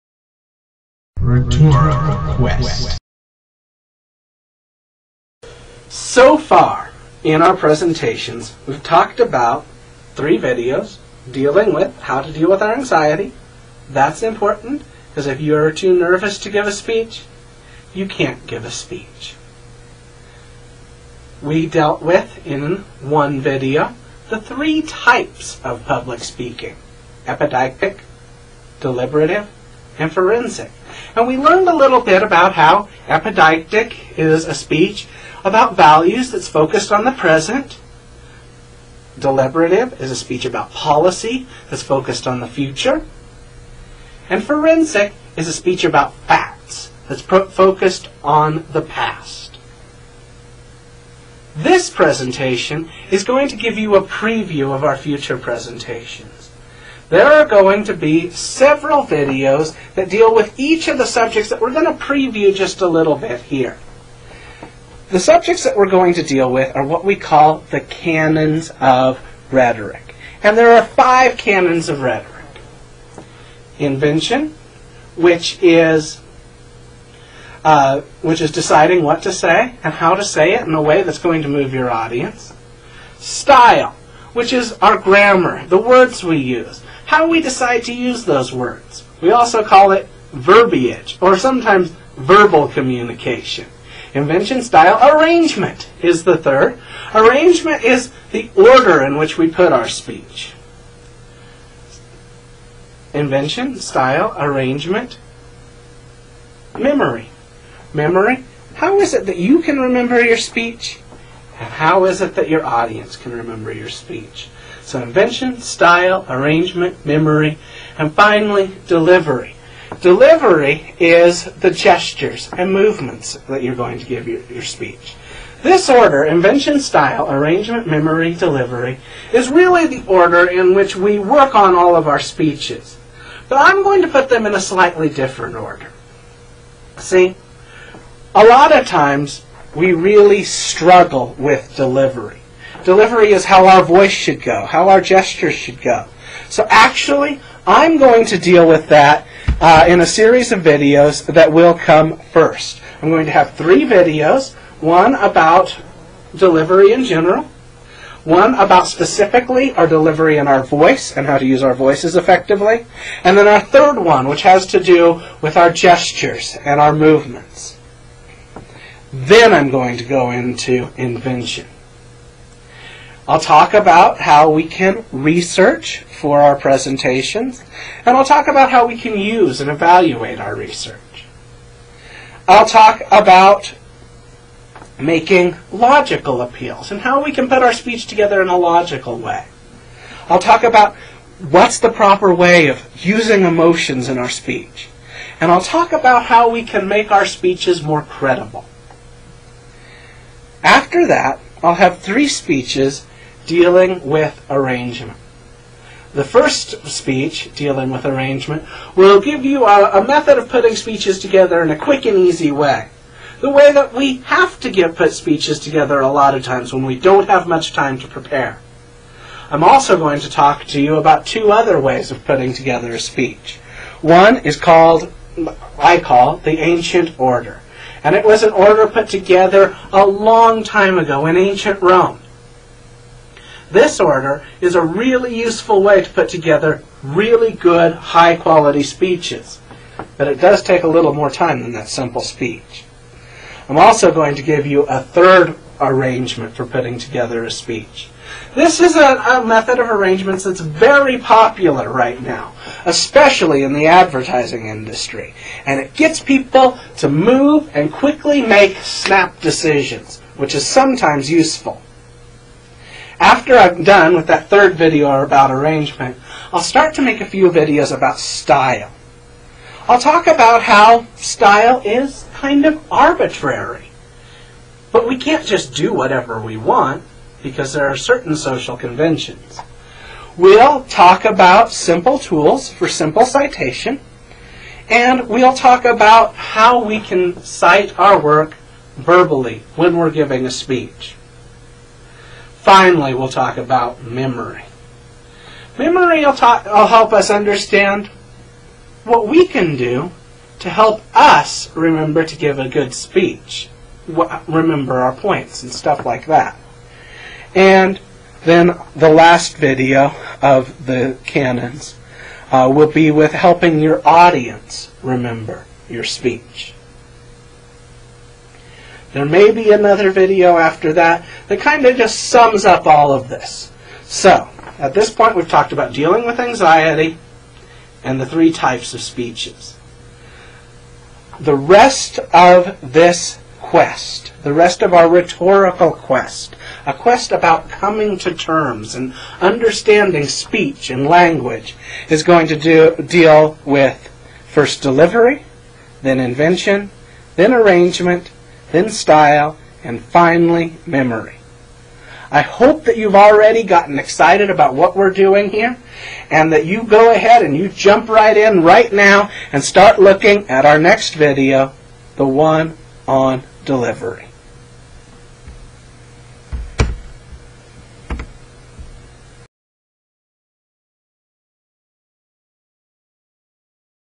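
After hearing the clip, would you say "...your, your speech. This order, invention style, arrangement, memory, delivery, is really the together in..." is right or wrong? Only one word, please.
wrong.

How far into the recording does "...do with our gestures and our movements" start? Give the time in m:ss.
2:44.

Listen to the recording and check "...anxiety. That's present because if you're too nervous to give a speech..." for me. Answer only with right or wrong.
wrong.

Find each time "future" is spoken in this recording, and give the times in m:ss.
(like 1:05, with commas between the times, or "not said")
0:42, 0:54.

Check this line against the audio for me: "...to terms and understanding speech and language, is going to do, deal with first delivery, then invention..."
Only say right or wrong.
right.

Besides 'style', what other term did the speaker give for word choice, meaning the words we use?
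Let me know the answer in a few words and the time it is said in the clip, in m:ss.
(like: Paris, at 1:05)
Verbiage, at 1:30.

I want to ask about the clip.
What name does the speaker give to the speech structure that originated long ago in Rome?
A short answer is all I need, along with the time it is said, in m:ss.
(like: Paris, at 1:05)
The ancient order, at 3:46.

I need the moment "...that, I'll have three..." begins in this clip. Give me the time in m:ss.
3:21.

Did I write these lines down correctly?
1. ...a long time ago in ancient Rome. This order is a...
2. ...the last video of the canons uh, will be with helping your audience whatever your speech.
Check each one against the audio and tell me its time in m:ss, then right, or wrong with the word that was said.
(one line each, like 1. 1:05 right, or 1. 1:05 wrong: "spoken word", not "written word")
1. 3:49 right
2. 5:08 wrong: "remember", not "whatever".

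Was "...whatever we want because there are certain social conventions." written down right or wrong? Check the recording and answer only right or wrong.
right.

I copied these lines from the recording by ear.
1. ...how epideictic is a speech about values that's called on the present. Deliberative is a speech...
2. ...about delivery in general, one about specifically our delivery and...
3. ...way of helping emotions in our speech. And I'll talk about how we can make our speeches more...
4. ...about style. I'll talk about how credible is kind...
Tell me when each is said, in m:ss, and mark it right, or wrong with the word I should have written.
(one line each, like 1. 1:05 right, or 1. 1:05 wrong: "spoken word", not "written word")
1. 0:32 wrong: "focused", not "called"
2. 2:35 right
3. 3:12 wrong: "using", not "helping"
4. 4:27 wrong: "style", not "credible".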